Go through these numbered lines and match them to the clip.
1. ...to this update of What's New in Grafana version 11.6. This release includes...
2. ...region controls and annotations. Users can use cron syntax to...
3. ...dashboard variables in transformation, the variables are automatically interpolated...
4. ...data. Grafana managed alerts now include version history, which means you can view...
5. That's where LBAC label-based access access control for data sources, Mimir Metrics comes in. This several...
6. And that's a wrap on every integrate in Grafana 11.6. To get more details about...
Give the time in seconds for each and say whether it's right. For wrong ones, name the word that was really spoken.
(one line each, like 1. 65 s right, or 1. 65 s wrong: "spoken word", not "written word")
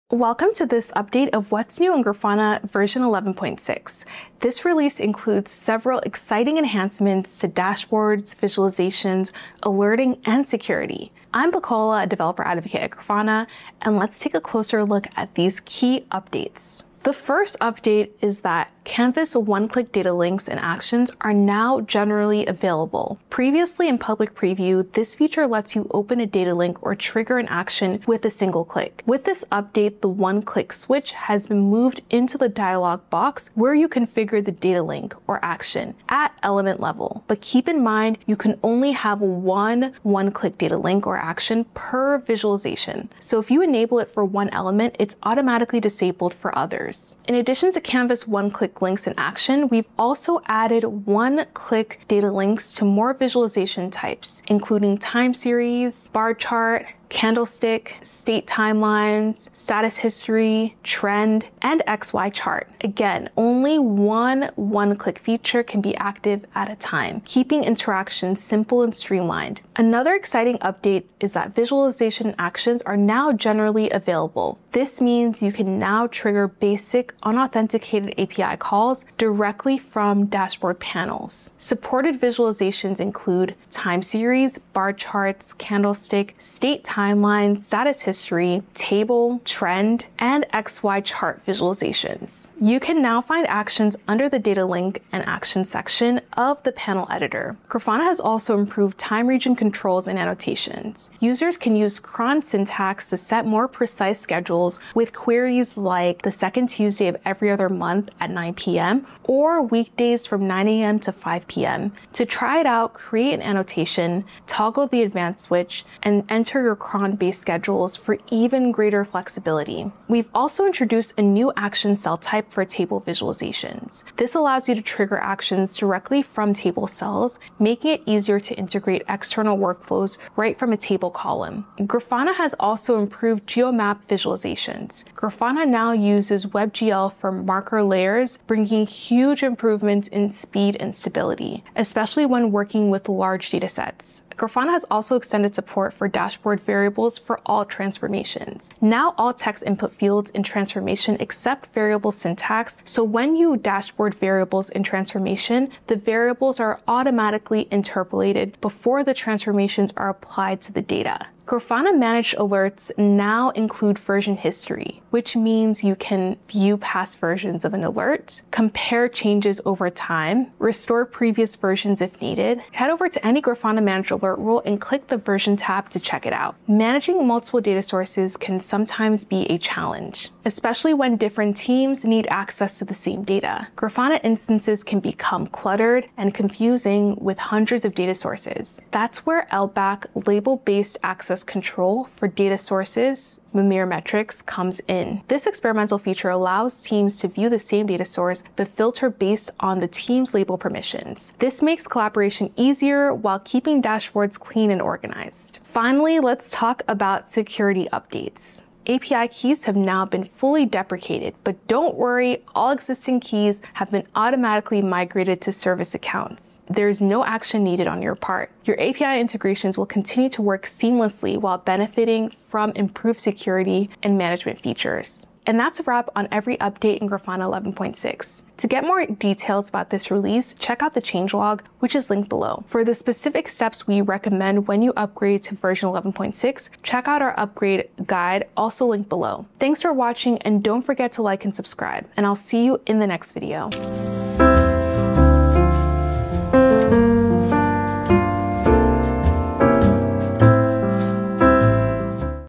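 1. 0 s right
2. 99 s right
3. 153 s right
4. 160 s right
5. 188 s wrong: "experimental", not "several"
6. 225 s wrong: "update", not "integrate".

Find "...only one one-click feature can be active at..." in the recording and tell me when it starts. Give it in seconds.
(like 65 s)
63 s.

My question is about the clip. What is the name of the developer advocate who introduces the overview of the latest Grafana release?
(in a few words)
Bacola.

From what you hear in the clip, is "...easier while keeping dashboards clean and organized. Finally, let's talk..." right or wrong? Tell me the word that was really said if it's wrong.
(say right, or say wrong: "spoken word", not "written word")
right.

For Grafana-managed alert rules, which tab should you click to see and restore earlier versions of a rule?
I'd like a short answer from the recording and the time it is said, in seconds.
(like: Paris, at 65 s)
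version tab, at 175 s.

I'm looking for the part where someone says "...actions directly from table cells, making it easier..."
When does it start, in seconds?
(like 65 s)
125 s.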